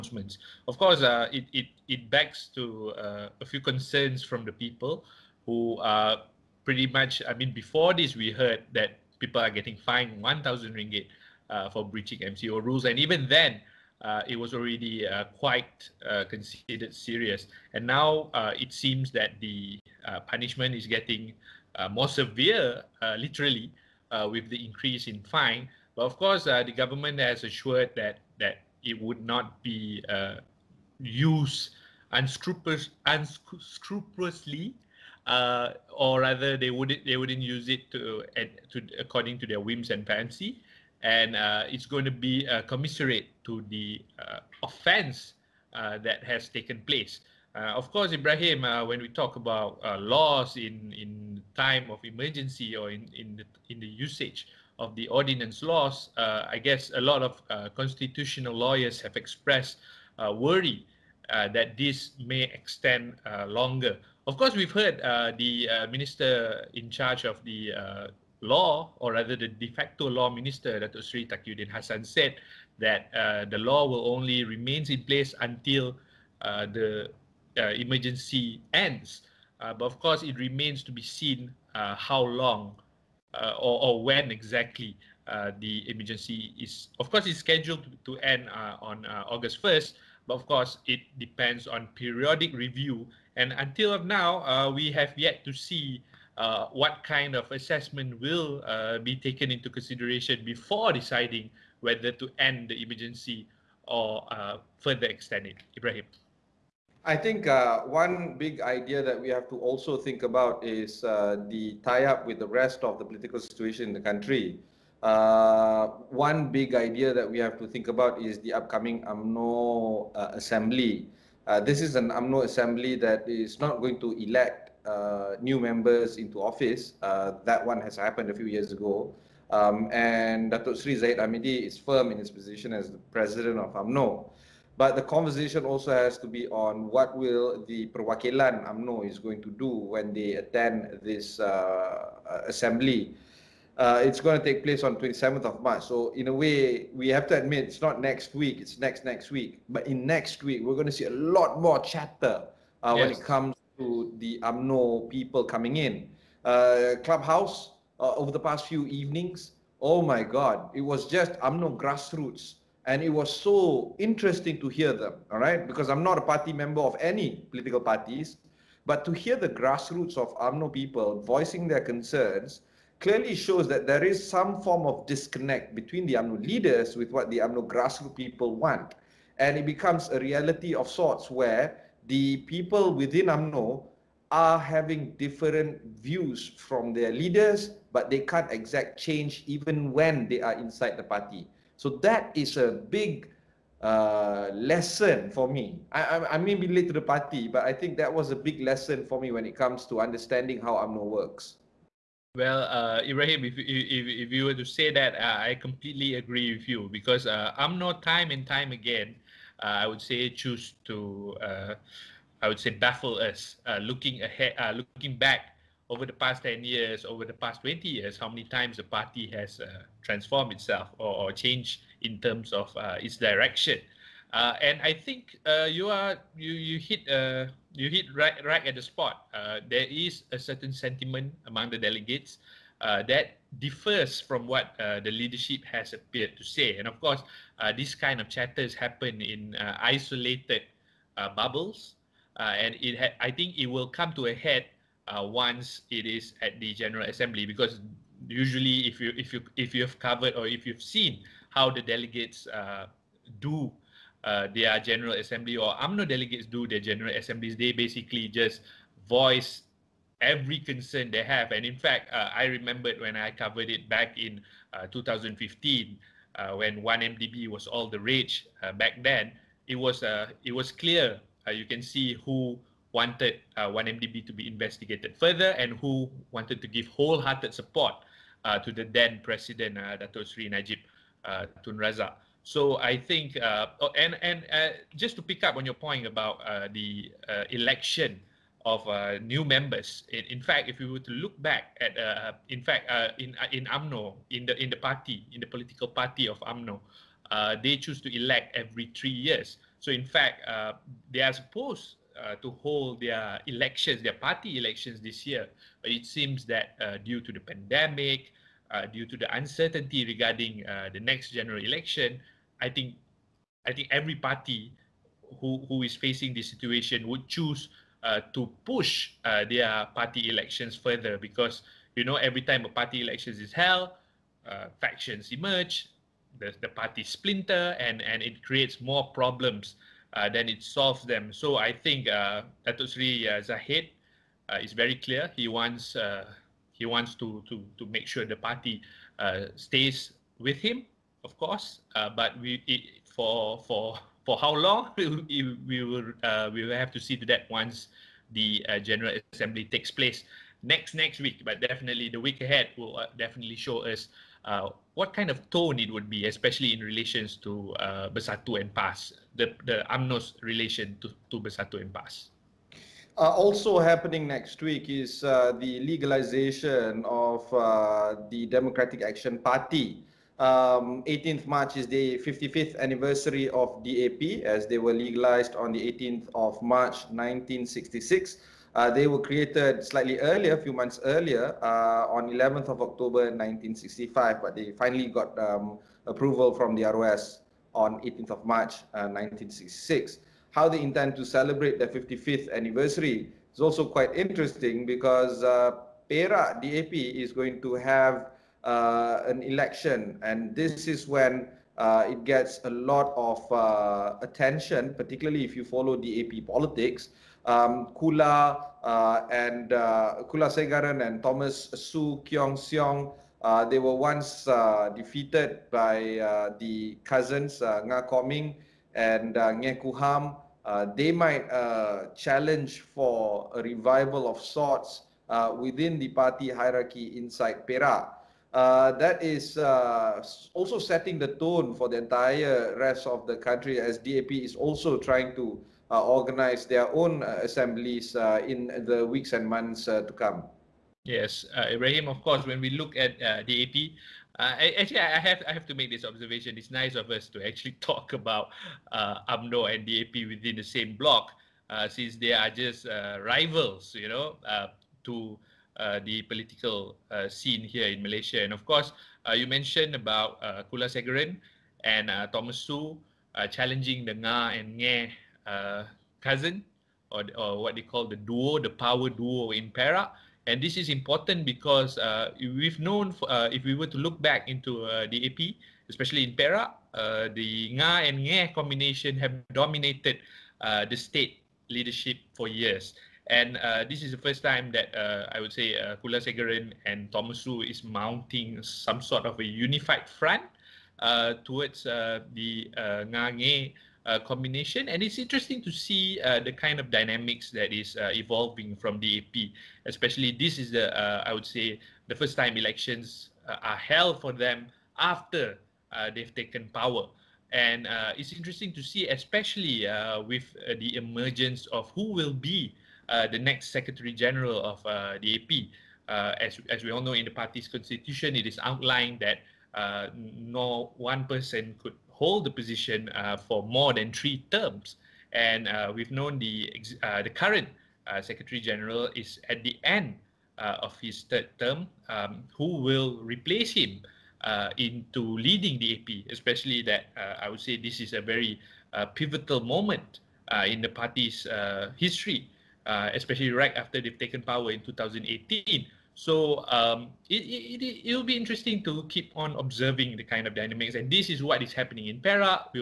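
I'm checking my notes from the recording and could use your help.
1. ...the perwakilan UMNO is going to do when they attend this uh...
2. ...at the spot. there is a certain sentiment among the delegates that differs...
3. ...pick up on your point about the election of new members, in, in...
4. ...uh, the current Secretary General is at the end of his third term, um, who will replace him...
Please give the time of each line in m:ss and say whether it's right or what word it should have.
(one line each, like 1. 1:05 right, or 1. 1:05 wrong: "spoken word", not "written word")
1. 2:17 right
2. 3:48 right
3. 4:45 right
4. 8:47 right.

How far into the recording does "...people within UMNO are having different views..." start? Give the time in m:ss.
3:02.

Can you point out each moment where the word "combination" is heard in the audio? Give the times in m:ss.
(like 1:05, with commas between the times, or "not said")
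7:58, 8:14.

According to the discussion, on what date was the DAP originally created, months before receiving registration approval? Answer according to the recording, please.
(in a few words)
11 October 1965.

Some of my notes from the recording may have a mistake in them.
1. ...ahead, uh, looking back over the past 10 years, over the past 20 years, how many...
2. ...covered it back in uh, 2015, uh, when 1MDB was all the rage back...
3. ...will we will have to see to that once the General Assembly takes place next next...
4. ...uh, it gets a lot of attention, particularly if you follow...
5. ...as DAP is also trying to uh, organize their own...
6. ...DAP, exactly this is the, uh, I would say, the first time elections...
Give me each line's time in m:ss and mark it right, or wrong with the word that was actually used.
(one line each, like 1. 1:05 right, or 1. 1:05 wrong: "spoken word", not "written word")
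1. 3:34 right
2. 4:23 right
3. 5:45 right
4. 6:41 right
5. 7:13 right
6. 8:18 wrong: "especially", not "exactly".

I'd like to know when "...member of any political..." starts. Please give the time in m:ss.
2:46.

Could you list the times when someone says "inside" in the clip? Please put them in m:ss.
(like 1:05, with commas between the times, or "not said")
3:10, 7:07.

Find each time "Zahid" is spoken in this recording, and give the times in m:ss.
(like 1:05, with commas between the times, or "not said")
2:10, 5:33.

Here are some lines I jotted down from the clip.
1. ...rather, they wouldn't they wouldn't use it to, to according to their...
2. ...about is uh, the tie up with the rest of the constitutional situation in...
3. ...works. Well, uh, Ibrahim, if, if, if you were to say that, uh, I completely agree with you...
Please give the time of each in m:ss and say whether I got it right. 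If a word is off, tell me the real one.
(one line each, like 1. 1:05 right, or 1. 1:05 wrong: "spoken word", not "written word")
1. 0:36 right
2. 1:50 wrong: "political", not "constitutional"
3. 3:21 right.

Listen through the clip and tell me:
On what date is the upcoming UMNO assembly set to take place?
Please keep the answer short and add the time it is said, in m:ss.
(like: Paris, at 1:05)
27th of March, at 2:24.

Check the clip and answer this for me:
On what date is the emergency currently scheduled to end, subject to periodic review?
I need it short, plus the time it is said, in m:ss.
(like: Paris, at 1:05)
August 1st, at 1:29.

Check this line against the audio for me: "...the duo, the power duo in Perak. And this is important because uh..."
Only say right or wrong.
right.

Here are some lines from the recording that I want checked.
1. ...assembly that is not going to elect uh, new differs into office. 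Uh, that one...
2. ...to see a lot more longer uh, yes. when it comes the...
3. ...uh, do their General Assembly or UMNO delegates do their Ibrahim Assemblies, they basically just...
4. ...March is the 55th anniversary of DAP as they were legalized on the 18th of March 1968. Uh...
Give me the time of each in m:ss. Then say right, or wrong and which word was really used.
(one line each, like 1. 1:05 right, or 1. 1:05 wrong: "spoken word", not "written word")
1. 2:02 wrong: "members", not "differs"
2. 2:30 wrong: "chatter", not "longer"
3. 4:12 wrong: "General", not "Ibrahim"
4. 6:11 wrong: "1966", not "1968".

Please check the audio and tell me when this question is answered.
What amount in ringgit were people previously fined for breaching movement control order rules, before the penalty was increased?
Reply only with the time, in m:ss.
0:10.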